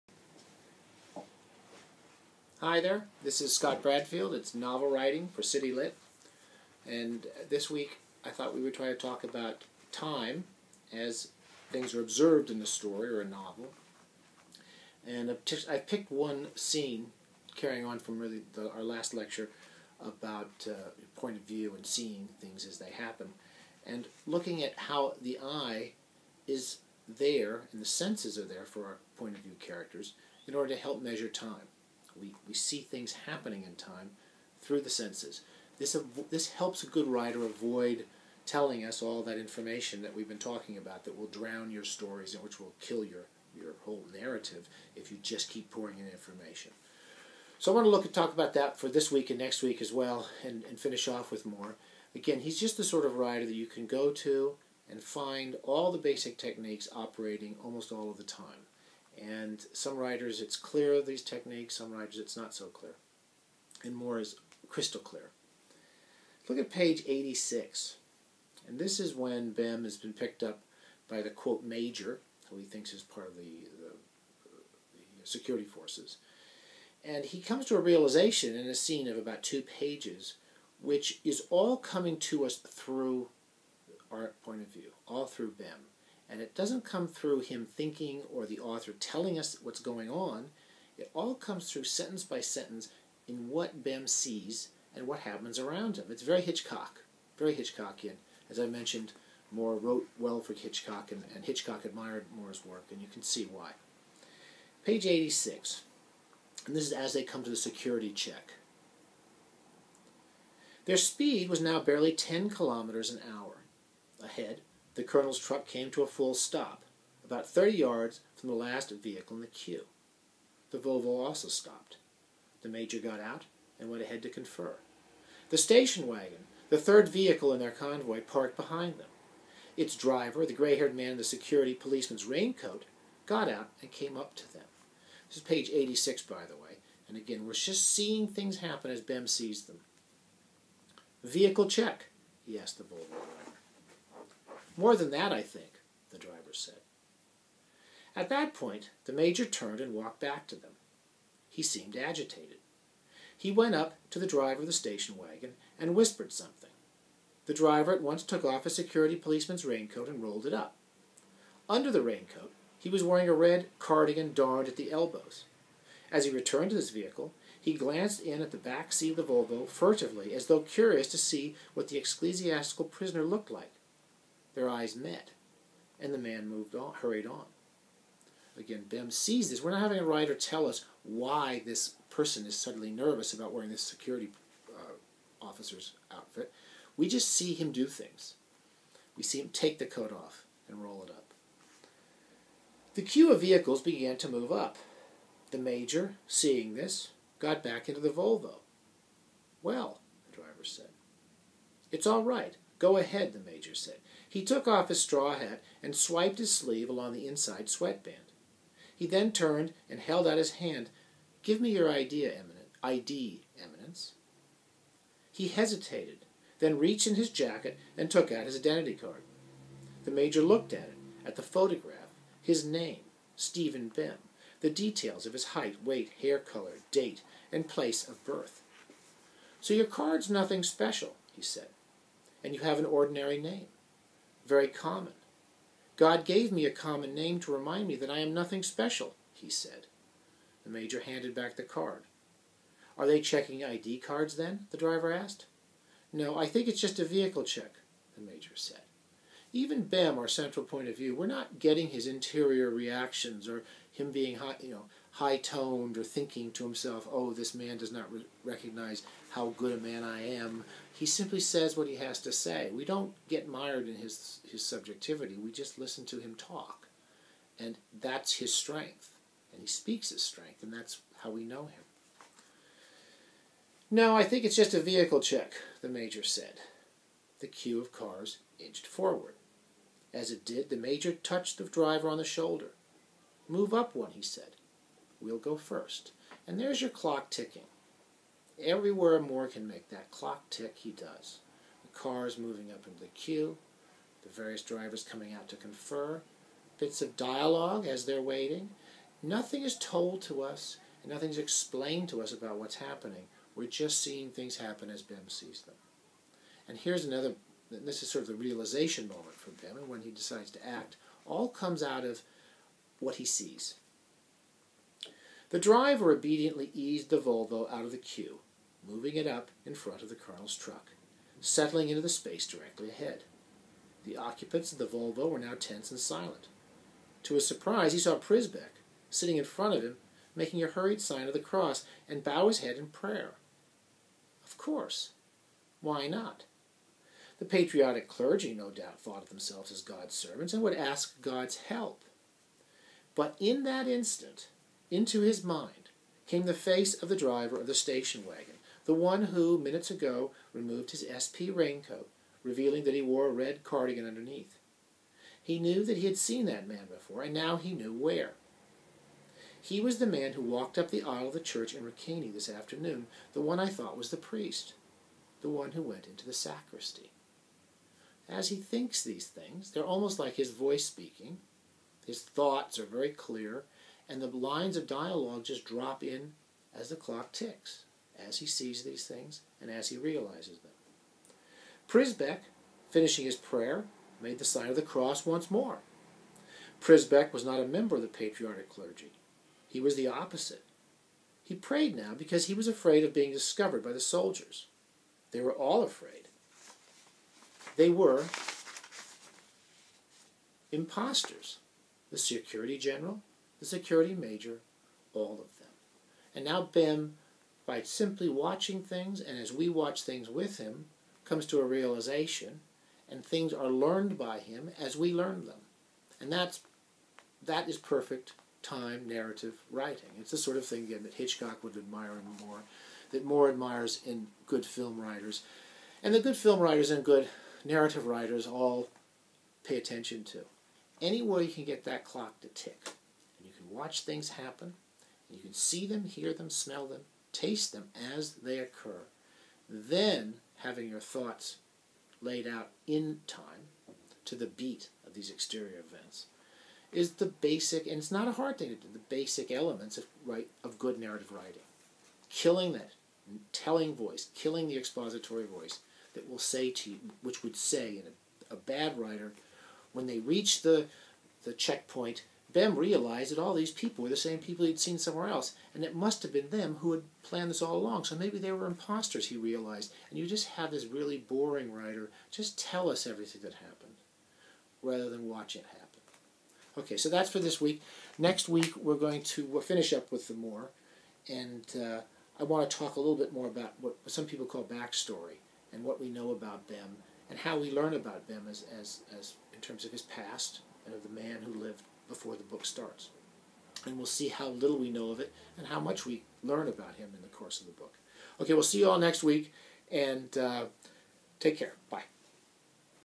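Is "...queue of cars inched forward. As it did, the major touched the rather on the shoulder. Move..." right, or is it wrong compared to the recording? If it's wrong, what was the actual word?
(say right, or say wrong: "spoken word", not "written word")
wrong: "driver", not "rather".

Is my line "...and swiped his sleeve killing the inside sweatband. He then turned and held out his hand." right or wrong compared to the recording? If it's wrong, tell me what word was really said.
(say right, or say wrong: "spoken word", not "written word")
wrong: "along", not "killing".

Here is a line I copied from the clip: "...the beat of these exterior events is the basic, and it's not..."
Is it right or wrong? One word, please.
right.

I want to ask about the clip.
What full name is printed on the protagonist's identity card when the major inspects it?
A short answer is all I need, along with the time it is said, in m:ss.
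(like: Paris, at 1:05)
Stephen Bem, at 3:43.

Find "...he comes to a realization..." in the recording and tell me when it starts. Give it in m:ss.
1:17.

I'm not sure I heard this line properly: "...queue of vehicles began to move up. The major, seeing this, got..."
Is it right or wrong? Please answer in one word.
right.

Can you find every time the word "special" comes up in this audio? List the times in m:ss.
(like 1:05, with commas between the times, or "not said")
3:50, 3:58.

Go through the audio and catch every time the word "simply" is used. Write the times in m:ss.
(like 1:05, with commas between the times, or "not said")
4:21, 6:47.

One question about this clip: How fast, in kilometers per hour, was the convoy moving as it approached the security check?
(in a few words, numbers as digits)
10.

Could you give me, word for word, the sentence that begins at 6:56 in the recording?
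And that's, that is perfect time narrative writing.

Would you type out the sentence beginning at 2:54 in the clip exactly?
Their eyes met, and the man moved on, hurried on.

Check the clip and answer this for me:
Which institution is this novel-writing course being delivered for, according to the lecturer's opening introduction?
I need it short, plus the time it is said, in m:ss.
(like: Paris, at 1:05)
City Lit, at 0:05.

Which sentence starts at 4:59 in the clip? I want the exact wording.
Nothing is told to us, and nothing's explained to us about what's happening.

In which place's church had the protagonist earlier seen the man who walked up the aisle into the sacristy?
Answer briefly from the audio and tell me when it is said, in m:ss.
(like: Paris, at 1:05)
Ricaney, at 6:01.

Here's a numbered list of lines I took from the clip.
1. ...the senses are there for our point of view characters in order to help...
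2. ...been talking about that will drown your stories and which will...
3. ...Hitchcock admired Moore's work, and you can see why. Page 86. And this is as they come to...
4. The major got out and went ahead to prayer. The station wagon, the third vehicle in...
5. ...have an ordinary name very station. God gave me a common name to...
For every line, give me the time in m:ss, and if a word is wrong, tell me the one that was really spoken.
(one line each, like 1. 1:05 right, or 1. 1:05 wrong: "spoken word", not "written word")
1. 0:27 right
2. 0:40 right
3. 1:41 right
4. 2:02 wrong: "confer", not "prayer"
5. 3:52 wrong: "common", not "station".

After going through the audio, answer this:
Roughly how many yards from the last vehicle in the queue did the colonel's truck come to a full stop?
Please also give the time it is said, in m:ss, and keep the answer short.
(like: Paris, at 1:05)
30 yards, at 1:57.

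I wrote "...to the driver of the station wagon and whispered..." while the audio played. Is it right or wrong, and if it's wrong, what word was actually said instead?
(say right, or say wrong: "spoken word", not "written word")
right.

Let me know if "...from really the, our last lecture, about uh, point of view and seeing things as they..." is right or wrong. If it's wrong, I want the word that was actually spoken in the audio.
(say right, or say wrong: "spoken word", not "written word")
right.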